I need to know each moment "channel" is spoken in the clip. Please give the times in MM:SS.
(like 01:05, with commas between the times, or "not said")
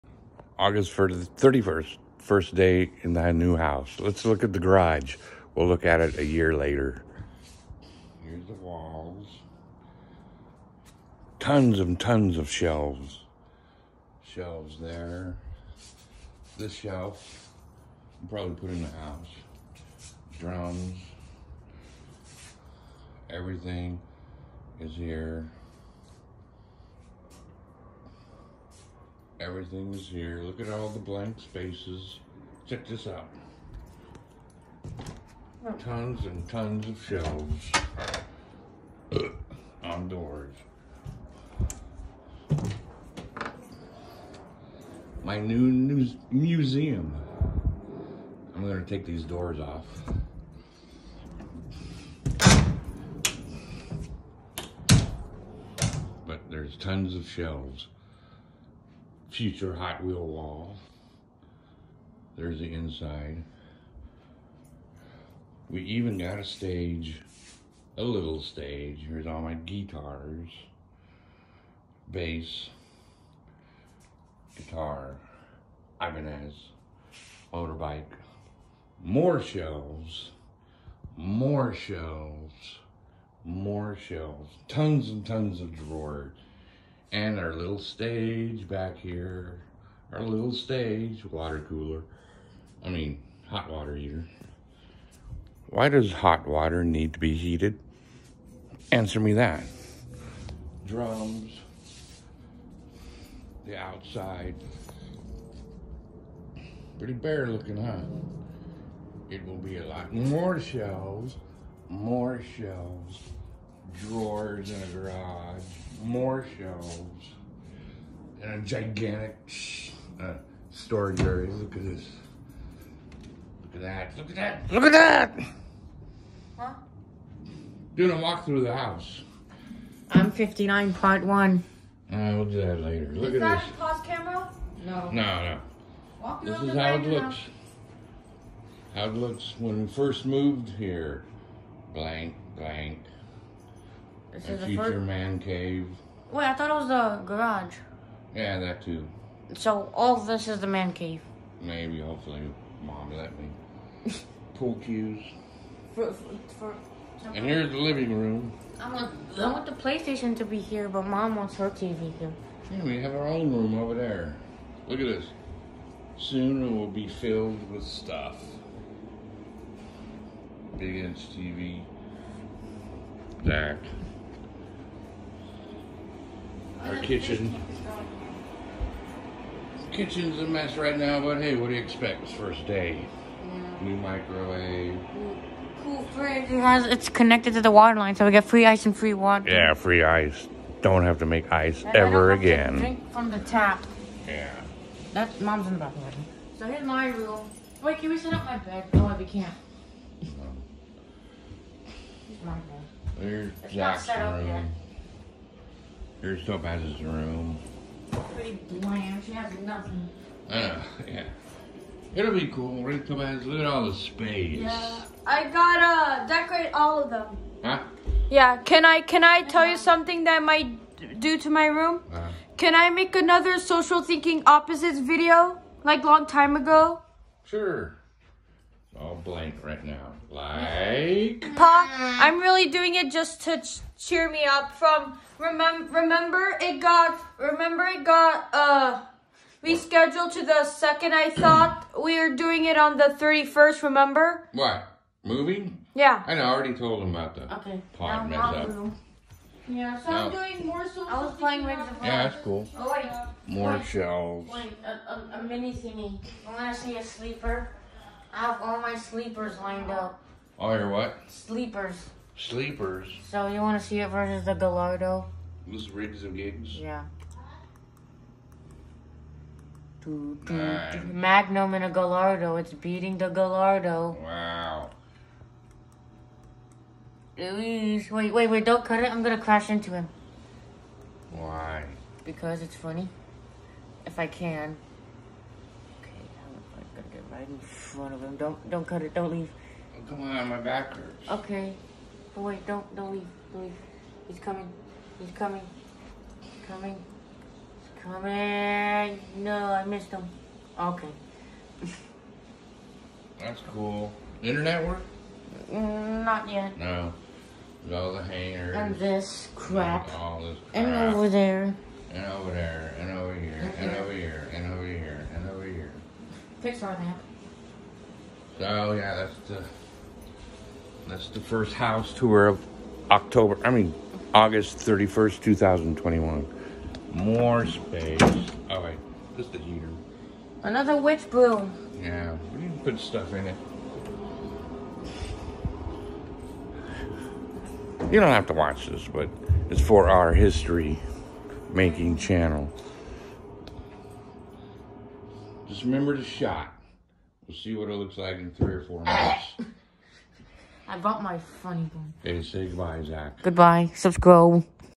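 05:42.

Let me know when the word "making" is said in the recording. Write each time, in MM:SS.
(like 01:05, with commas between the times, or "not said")
05:41.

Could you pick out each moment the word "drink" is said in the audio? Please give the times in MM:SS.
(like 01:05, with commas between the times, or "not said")
03:12.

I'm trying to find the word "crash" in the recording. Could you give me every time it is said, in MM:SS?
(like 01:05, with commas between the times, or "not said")
04:39.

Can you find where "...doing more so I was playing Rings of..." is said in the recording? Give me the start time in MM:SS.
04:10.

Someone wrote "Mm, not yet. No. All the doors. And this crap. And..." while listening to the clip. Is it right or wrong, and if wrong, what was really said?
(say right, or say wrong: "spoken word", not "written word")
wrong: "hangers", not "doors".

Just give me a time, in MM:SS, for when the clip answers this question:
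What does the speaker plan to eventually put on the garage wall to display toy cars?
00:59.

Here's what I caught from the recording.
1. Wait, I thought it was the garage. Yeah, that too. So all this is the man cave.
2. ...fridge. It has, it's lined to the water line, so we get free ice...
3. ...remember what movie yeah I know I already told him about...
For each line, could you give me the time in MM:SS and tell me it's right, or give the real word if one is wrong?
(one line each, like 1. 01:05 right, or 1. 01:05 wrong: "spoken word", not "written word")
1. 02:26 right
2. 03:06 wrong: "connected", not "lined"
3. 04:03 right.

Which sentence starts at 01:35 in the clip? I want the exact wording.
Why does hot water need to be heated?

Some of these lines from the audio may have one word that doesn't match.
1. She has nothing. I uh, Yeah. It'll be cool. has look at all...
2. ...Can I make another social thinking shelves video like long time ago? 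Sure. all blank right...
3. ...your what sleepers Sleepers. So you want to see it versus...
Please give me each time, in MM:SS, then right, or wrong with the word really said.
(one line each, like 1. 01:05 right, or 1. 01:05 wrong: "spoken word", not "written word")
1. 03:29 right
2. 03:42 wrong: "opposites", not "shelves"
3. 04:20 right.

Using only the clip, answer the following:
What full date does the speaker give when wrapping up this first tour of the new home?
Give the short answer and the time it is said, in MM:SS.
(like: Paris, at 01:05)
August 31st, 2021, at 05:24.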